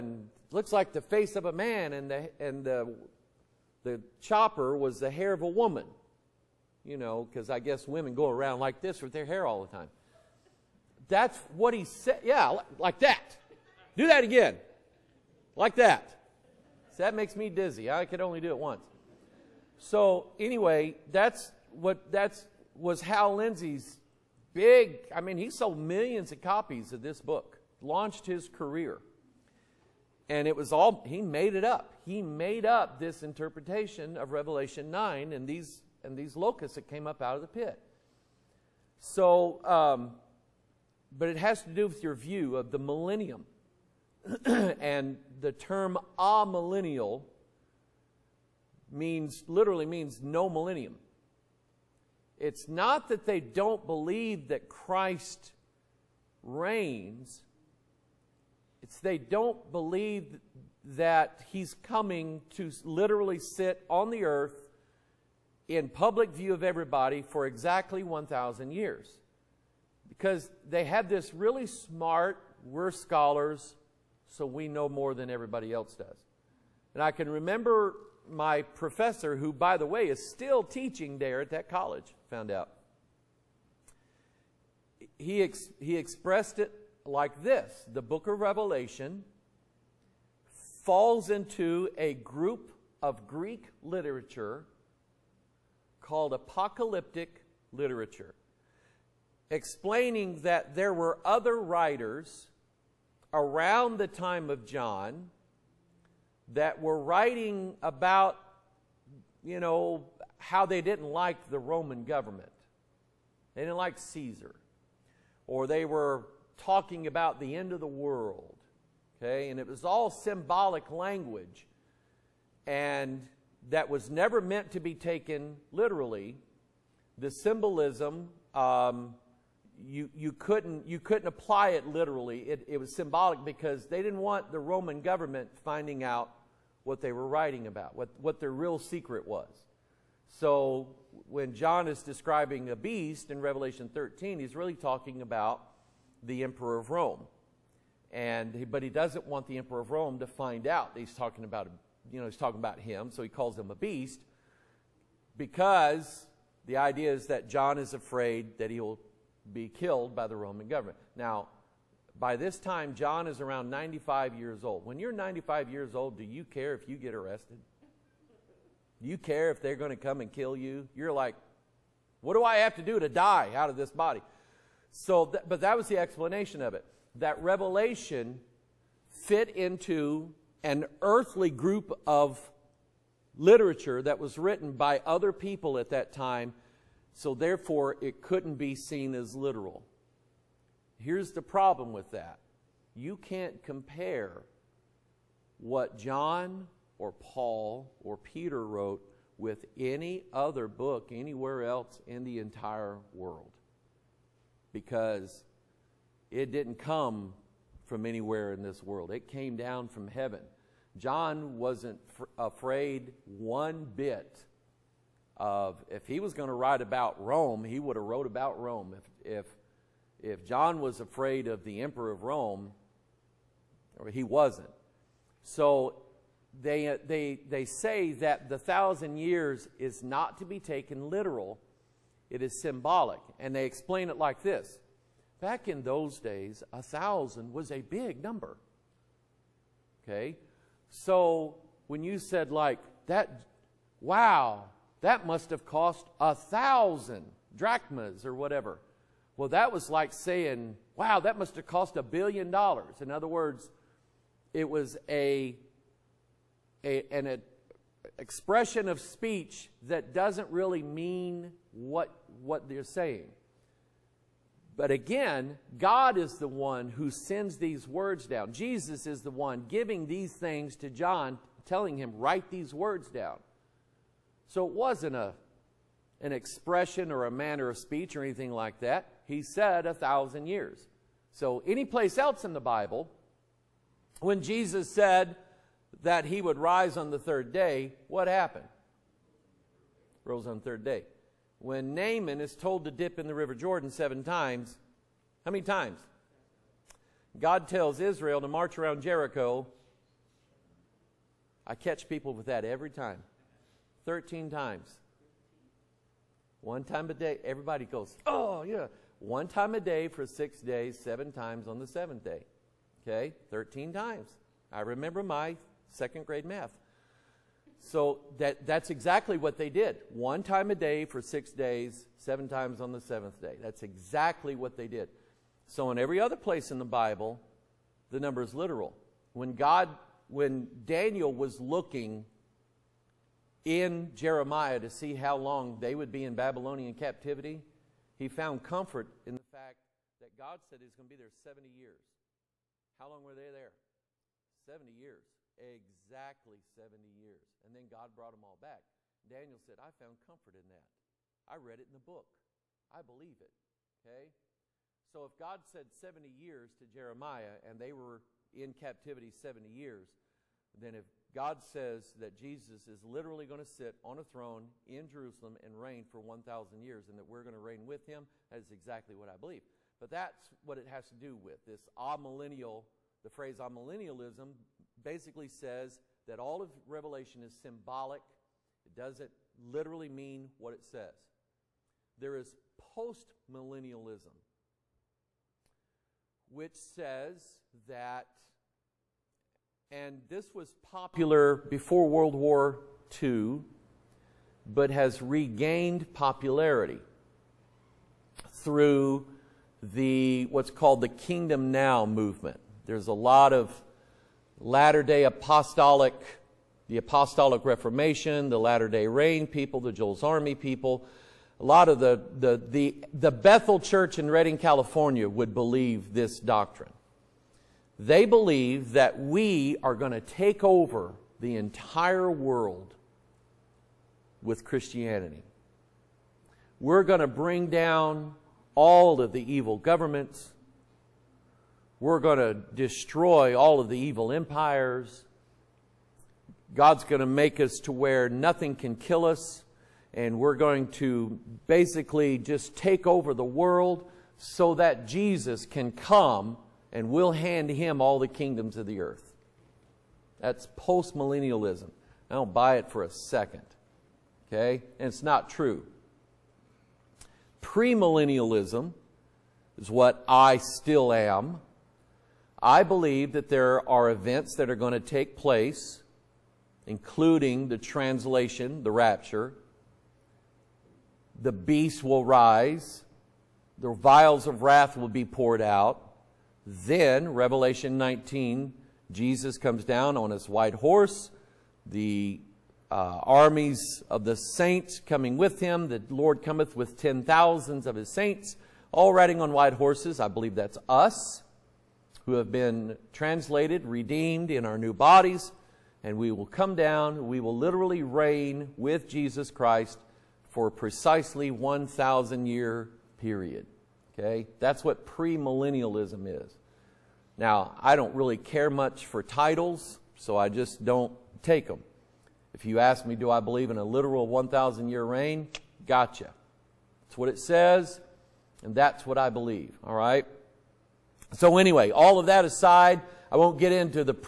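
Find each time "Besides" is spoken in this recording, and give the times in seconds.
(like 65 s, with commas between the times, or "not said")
not said.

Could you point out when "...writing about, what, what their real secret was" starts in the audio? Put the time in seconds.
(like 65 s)
137 s.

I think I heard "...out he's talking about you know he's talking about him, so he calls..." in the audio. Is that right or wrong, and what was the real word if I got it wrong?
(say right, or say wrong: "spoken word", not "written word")
right.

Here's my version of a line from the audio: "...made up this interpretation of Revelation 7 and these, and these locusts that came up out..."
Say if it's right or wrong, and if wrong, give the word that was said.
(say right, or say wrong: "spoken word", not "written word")
wrong: "9", not "7".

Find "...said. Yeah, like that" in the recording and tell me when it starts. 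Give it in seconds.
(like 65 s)
11 s.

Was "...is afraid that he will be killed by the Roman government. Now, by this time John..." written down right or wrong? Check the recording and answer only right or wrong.
right.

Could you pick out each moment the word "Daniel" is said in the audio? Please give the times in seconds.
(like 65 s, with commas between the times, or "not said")
330 s, 349 s.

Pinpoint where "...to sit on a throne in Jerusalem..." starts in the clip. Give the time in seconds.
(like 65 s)
363 s.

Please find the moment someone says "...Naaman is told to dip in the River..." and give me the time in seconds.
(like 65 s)
291 s.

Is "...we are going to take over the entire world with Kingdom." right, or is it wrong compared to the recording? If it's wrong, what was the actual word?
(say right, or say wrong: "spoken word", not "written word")
wrong: "Christianity", not "Kingdom".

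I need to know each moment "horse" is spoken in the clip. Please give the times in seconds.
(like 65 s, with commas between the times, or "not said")
480 s, 489 s.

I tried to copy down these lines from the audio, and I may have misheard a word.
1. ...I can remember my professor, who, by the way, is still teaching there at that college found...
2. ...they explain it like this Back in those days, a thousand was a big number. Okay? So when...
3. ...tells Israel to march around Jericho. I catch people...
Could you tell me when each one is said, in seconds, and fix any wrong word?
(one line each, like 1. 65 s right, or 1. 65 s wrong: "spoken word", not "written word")
1. 77 s right
2. 233 s right
3. 297 s right.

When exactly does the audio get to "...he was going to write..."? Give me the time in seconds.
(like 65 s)
216 s.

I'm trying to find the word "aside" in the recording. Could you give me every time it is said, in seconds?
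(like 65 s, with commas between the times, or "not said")
522 s.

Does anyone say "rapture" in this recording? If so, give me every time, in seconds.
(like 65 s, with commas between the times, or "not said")
468 s.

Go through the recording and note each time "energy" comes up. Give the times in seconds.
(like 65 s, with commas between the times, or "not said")
not said.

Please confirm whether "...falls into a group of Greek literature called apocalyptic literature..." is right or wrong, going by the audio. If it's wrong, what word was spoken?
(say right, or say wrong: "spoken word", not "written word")
right.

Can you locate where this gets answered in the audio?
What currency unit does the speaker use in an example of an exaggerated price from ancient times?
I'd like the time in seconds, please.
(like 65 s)
247 s.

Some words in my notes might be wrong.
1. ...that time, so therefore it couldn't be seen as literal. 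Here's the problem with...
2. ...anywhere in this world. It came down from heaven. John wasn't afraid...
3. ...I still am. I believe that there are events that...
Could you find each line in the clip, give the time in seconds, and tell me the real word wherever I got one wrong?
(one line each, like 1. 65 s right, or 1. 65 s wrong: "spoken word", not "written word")
1. 185 s right
2. 208 s right
3. 460 s right.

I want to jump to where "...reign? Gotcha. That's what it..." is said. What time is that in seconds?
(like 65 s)
515 s.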